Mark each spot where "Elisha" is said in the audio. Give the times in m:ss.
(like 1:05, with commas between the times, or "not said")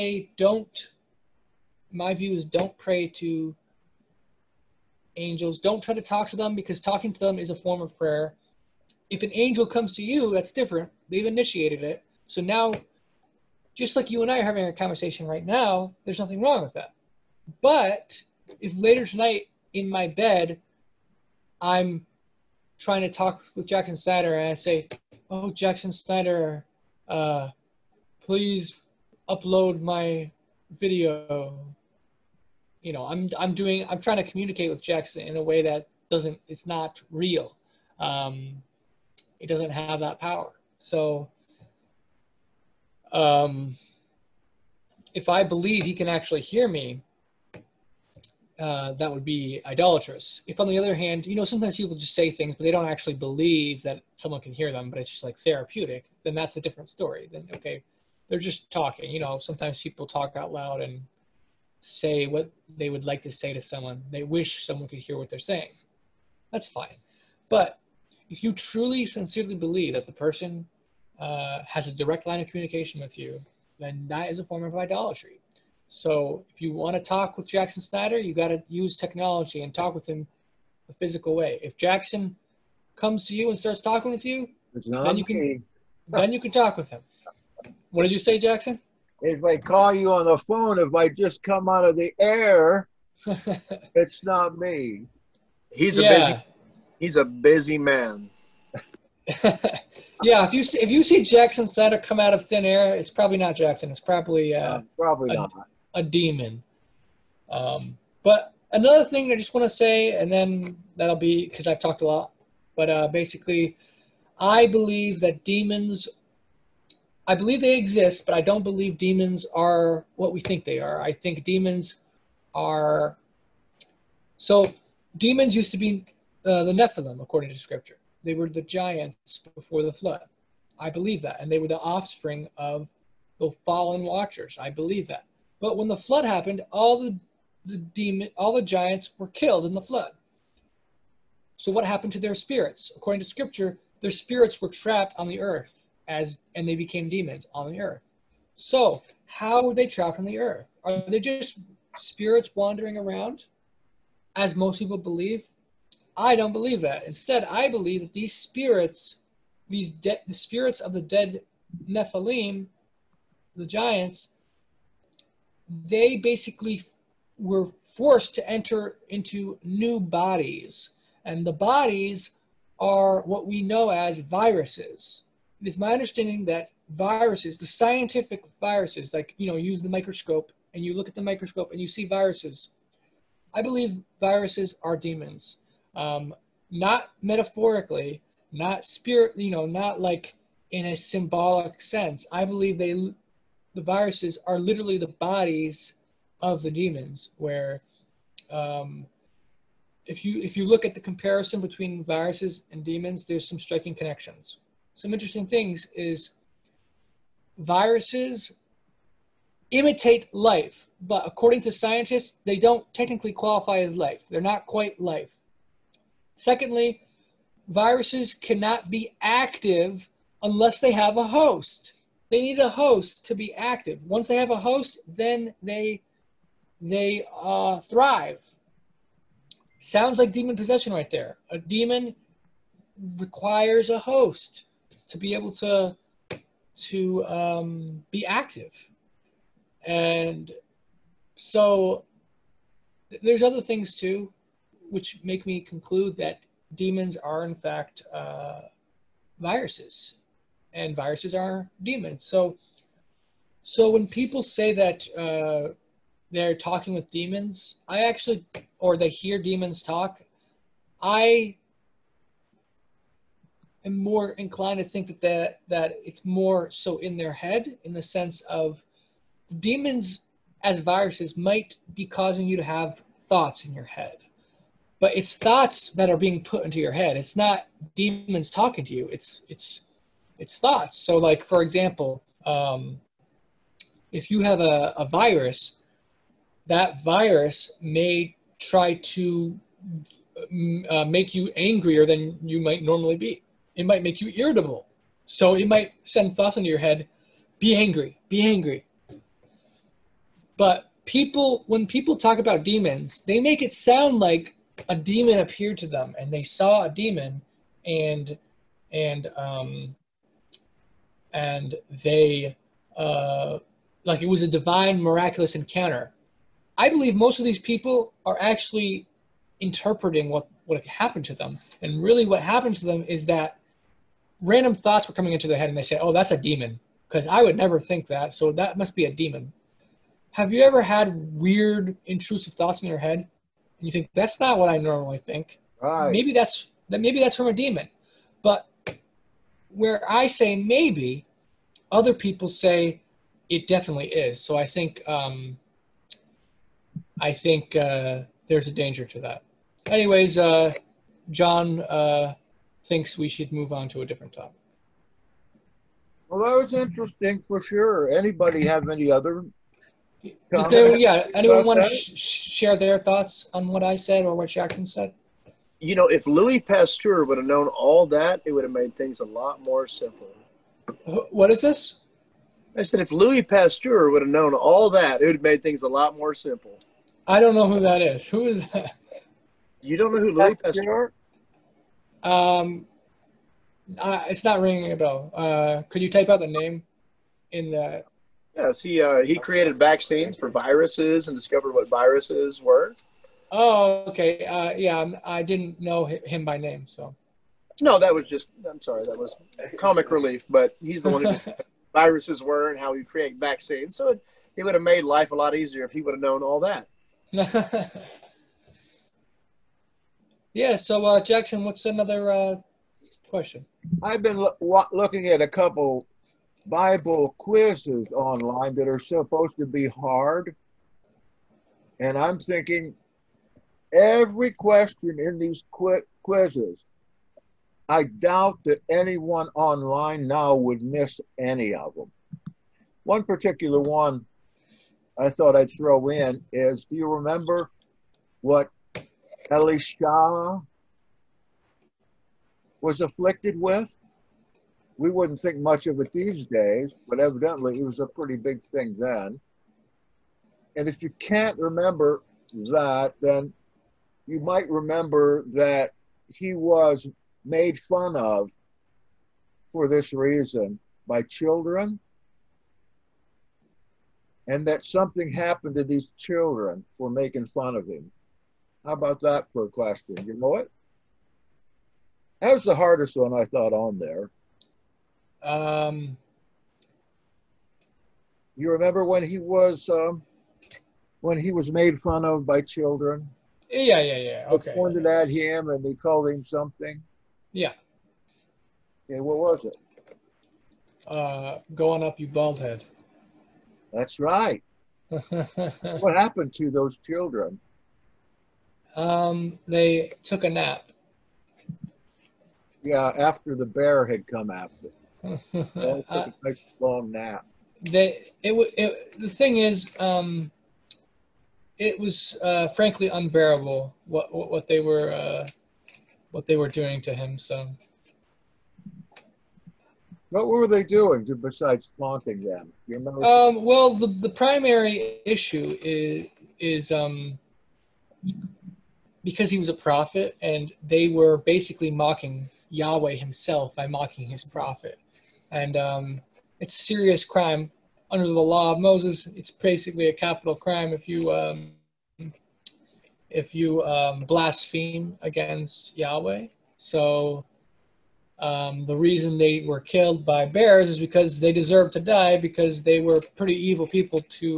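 7:19.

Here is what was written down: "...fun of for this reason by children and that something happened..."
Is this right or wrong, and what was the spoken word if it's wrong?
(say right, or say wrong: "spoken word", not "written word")
right.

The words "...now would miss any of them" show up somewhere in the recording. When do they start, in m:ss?
7:10.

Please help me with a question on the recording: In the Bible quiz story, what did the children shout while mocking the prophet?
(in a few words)
Going up, you bald head.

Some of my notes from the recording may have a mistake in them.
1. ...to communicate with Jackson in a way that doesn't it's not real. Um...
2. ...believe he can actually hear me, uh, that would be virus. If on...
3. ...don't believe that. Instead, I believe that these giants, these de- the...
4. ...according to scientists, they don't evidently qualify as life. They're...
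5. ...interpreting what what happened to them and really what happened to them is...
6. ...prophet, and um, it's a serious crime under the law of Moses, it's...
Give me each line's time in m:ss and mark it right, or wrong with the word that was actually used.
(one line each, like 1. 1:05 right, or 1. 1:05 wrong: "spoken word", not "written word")
1. 0:34 right
2. 0:45 wrong: "idolatrous", not "virus"
3. 2:36 wrong: "spirits", not "giants"
4. 3:31 wrong: "technically", not "evidently"
5. 5:19 right
6. 8:54 right.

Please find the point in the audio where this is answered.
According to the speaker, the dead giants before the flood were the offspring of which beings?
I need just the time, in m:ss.
2:13.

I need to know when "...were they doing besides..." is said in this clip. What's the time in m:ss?
8:40.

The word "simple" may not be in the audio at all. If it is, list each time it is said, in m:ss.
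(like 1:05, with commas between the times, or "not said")
6:09, 6:16.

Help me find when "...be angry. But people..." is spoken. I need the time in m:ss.
4:58.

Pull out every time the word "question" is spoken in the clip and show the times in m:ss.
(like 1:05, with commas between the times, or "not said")
6:53, 7:04, 7:49.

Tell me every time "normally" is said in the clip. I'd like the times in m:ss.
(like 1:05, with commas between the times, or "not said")
4:52, 5:34.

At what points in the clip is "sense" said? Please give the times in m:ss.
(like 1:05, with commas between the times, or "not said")
3:11, 4:28.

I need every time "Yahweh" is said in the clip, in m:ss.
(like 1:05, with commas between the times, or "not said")
8:52, 9:05.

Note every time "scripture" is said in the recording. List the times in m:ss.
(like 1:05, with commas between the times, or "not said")
2:07, 2:23.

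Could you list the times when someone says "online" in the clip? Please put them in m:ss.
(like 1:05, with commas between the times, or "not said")
6:58, 7:09.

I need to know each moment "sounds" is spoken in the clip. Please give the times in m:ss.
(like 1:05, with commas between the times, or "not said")
3:49, 5:03.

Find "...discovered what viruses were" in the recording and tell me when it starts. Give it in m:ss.
6:31.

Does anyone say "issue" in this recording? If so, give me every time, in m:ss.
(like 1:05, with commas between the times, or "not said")
8:45.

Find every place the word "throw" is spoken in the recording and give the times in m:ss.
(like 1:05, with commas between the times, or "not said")
7:15.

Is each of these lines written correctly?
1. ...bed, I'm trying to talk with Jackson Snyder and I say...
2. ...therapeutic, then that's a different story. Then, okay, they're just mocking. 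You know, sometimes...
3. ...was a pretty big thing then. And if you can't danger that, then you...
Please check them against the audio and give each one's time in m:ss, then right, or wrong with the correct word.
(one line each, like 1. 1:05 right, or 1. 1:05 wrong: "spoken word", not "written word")
1. 0:20 right
2. 0:55 wrong: "talking", not "mocking"
3. 7:27 wrong: "remember", not "danger".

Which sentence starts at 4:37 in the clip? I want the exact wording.
It's not demons talking to you.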